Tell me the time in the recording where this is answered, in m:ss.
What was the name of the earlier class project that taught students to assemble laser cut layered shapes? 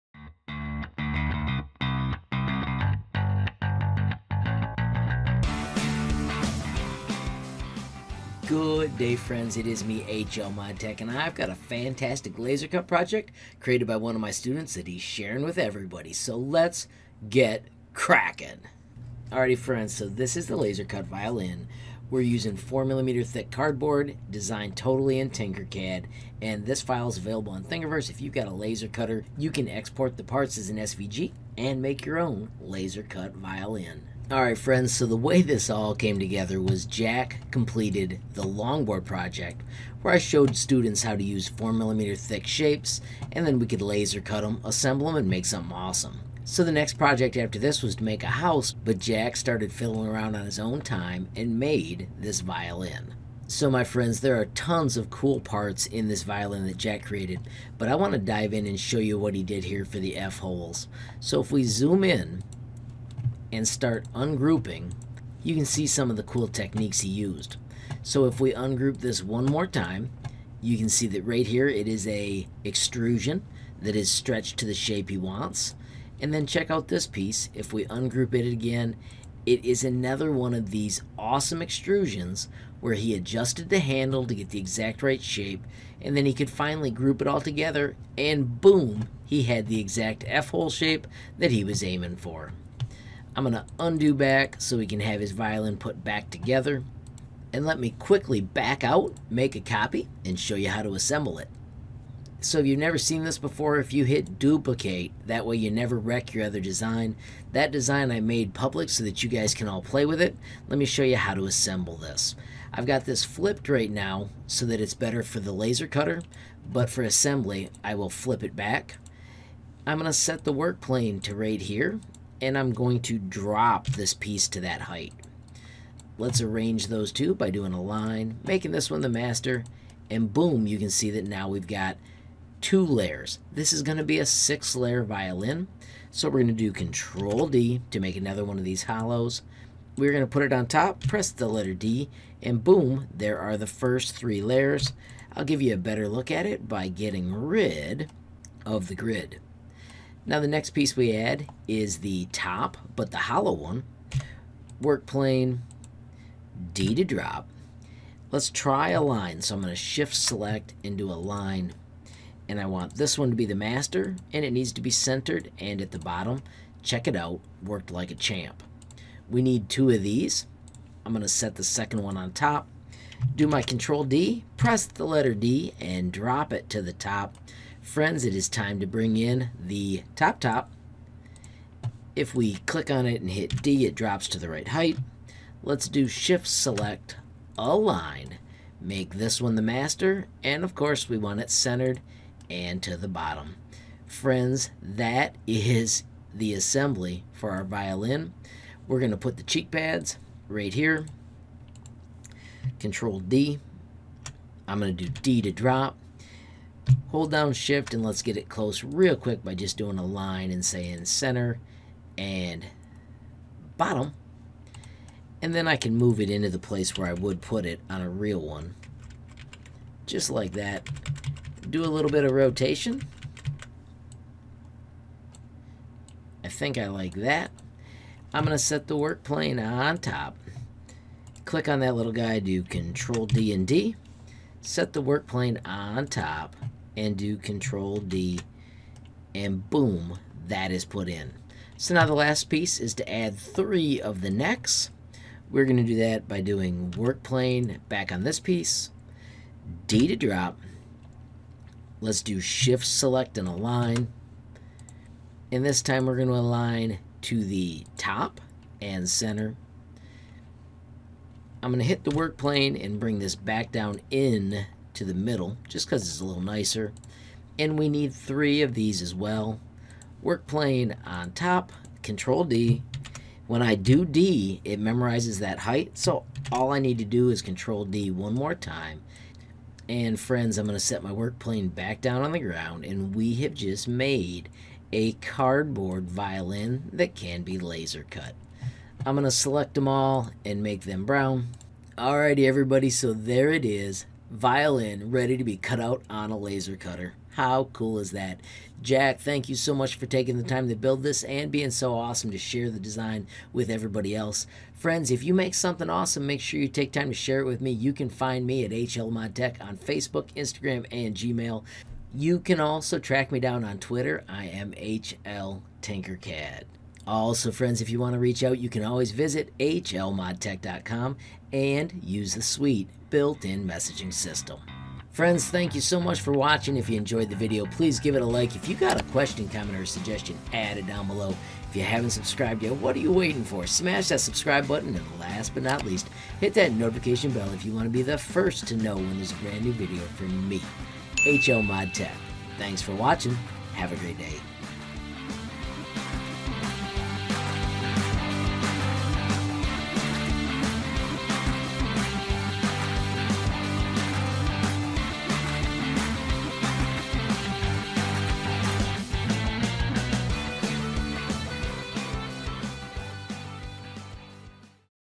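0:38.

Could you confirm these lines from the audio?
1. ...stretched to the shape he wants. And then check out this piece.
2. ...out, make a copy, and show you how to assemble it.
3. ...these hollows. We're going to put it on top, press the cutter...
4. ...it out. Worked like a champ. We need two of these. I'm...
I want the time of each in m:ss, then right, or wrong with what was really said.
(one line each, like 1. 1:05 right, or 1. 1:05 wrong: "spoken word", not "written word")
1. 1:14 right
2. 1:38 right
3. 2:18 wrong: "letter", not "cutter"
4. 2:47 right.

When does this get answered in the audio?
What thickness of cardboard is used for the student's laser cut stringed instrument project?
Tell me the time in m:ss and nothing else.
0:22.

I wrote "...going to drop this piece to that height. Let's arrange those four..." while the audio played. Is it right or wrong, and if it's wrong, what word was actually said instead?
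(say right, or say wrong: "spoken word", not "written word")
wrong: "two", not "four".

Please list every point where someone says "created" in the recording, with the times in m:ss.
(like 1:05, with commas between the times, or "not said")
0:13, 0:57.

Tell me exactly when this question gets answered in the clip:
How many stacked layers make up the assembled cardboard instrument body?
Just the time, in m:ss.
2:14.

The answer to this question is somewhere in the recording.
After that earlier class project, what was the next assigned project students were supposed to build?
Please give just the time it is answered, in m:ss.
0:48.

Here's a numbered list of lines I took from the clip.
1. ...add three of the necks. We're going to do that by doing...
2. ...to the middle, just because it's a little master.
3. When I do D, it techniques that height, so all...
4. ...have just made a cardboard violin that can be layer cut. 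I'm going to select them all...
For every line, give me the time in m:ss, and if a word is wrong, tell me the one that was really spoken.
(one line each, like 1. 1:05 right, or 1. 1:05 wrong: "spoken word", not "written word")
1. 4:03 right
2. 4:24 wrong: "nicer", not "master"
3. 4:33 wrong: "memorizes", not "techniques"
4. 4:43 wrong: "laser", not "layer".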